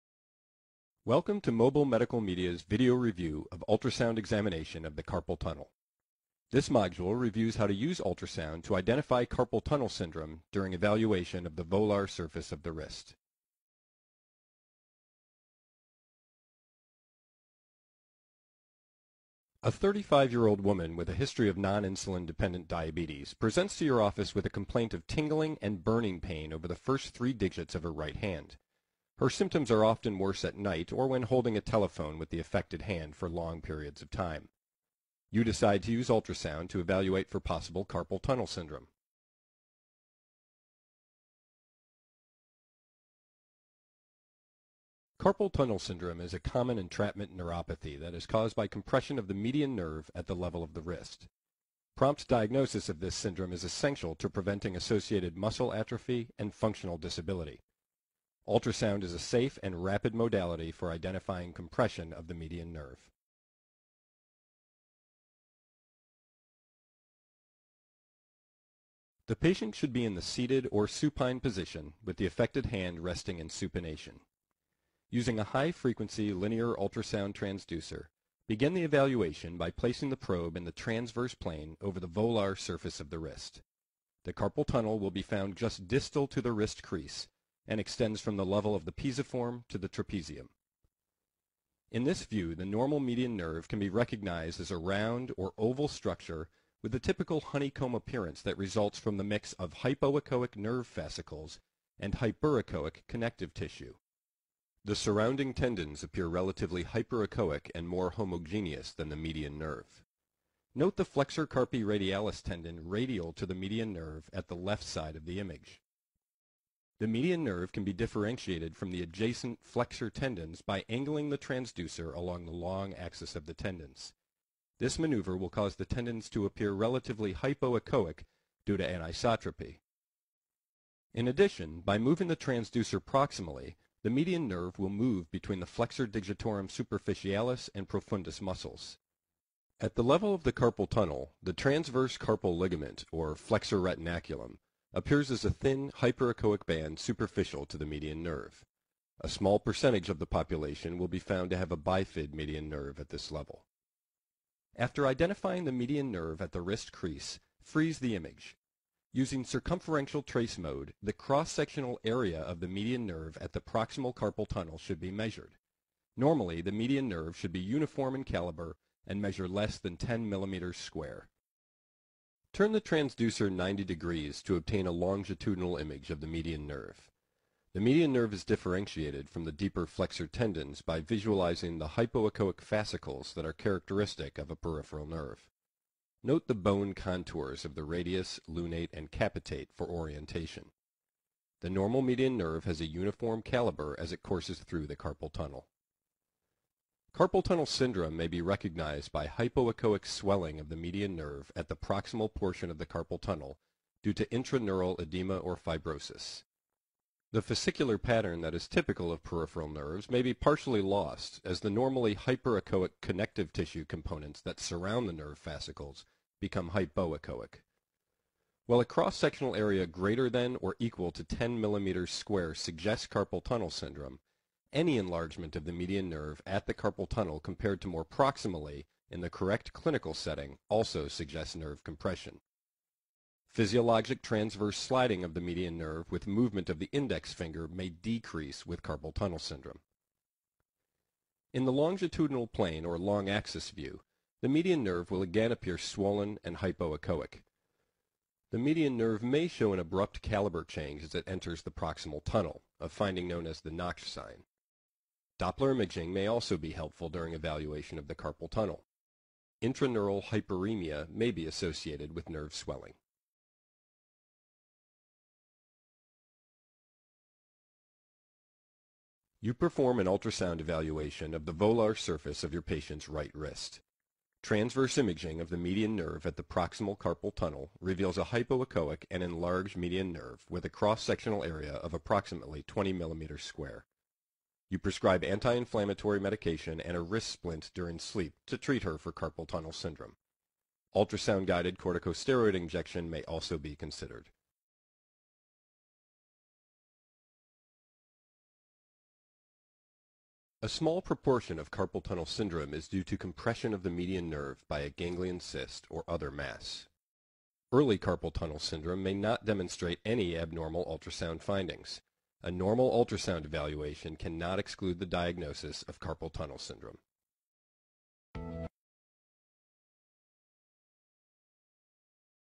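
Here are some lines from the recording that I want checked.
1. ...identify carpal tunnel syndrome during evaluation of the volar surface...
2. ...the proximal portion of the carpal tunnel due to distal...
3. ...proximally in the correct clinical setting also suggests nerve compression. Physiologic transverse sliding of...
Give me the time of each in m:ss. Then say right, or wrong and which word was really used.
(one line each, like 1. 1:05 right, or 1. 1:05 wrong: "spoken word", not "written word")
1. 0:08 right
2. 3:21 wrong: "intraneural", not "distal"
3. 3:48 right.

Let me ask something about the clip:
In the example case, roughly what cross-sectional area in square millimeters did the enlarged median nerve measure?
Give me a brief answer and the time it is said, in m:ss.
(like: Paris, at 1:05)
20, at 4:42.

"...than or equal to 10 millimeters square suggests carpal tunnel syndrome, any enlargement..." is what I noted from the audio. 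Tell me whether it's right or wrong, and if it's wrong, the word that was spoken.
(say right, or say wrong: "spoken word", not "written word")
right.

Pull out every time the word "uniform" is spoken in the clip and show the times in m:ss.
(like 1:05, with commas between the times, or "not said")
2:47, 3:12.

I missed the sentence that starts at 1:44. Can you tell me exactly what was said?
The surrounding tendons appear relatively hyperechoic and more homogeneous than the median nerve.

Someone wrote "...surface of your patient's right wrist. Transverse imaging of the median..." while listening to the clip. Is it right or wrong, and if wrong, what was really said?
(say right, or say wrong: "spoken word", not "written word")
right.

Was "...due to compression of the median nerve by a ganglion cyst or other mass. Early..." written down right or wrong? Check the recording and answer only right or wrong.
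right.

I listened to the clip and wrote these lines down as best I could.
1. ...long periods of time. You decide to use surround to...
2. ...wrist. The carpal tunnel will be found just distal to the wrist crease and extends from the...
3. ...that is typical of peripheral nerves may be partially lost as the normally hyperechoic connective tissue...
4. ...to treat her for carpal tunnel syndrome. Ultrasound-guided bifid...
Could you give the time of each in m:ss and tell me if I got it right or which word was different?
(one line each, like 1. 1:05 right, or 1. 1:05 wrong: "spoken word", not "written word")
1. 0:33 wrong: "ultrasound", not "surround"
2. 1:23 right
3. 3:28 right
4. 4:48 wrong: "corticosteroid", not "bifid".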